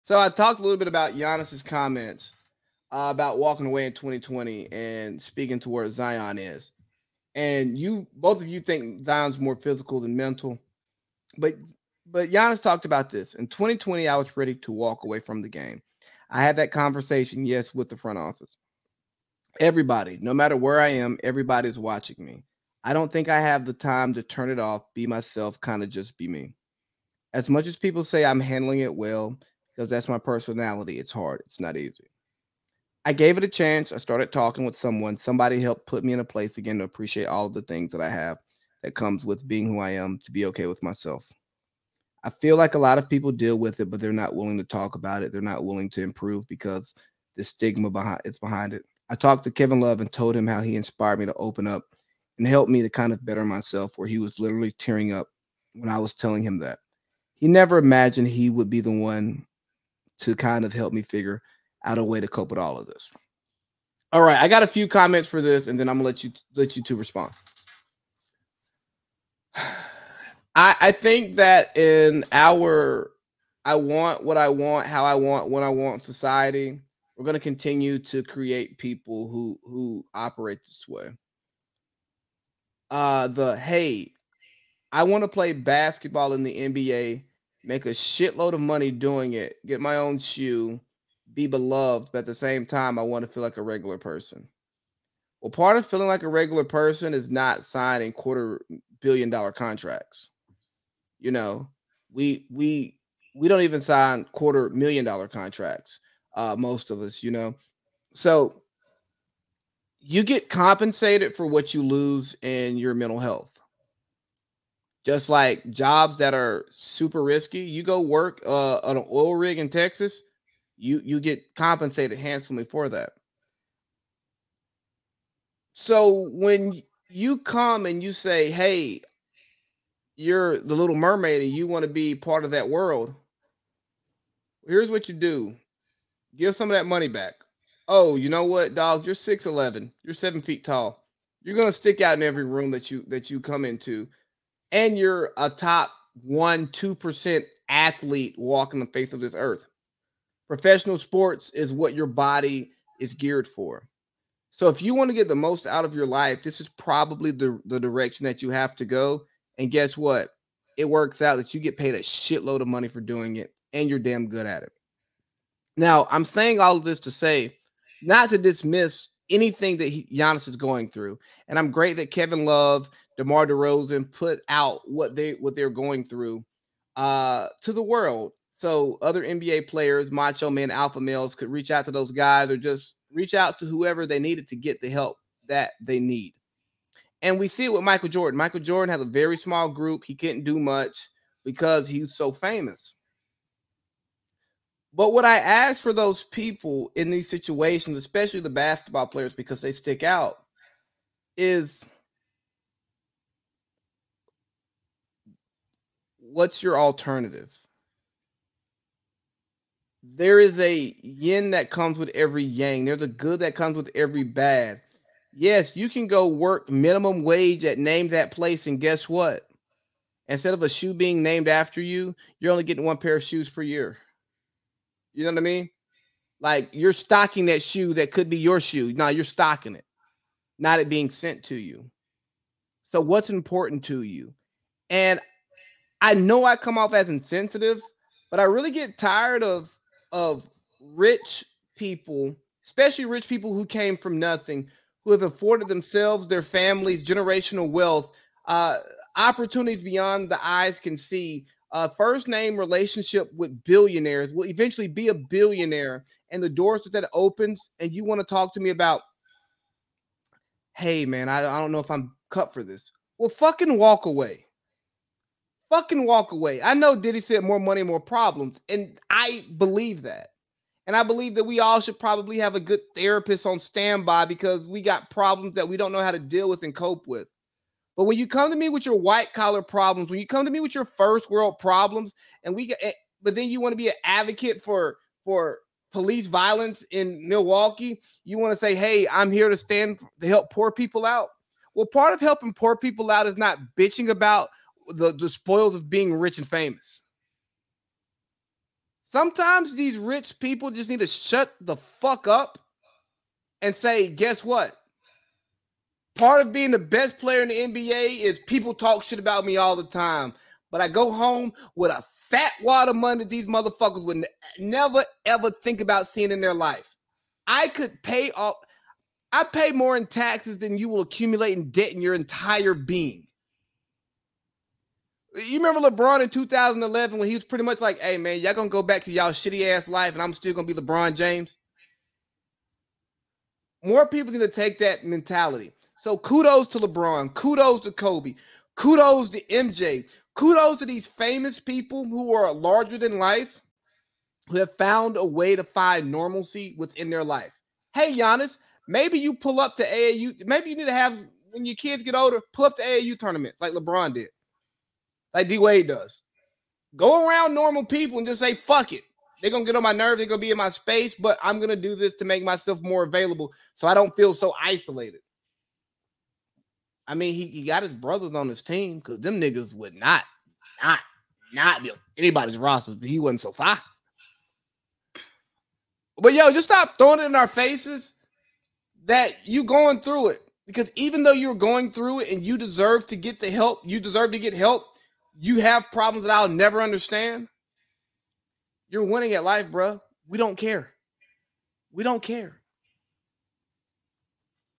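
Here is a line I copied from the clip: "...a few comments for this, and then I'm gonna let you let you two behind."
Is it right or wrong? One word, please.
wrong.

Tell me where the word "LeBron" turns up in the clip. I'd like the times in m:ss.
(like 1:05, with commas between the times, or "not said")
5:25, 5:30, 5:36, 5:53.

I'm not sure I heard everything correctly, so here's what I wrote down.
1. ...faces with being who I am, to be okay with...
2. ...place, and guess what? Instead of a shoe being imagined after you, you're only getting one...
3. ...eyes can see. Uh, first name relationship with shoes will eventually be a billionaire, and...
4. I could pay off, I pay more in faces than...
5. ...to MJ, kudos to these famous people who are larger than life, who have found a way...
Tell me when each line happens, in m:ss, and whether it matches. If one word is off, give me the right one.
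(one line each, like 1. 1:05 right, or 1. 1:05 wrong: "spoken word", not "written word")
1. 0:38 wrong: "comes", not "faces"
2. 3:38 wrong: "named", not "imagined"
3. 4:10 wrong: "billionaires", not "shoes"
4. 5:17 wrong: "taxes", not "faces"
5. 5:39 right.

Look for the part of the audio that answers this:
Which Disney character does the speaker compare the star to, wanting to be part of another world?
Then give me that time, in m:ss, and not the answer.
2:10.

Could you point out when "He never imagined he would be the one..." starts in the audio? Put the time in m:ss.
0:57.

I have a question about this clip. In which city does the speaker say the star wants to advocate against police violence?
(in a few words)
Milwaukee.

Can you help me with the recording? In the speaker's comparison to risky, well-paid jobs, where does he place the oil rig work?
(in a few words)
Texas.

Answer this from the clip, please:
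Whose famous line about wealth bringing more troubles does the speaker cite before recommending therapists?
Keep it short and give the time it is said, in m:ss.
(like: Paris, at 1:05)
Diddy, at 4:26.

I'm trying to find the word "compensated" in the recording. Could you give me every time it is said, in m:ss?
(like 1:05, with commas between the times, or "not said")
1:50, 2:01.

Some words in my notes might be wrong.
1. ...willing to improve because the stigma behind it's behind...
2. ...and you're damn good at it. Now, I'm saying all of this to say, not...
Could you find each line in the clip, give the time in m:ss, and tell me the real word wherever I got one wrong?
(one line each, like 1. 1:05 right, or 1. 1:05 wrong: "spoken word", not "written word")
1. 0:45 right
2. 2:43 right.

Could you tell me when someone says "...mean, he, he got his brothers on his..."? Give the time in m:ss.
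6:07.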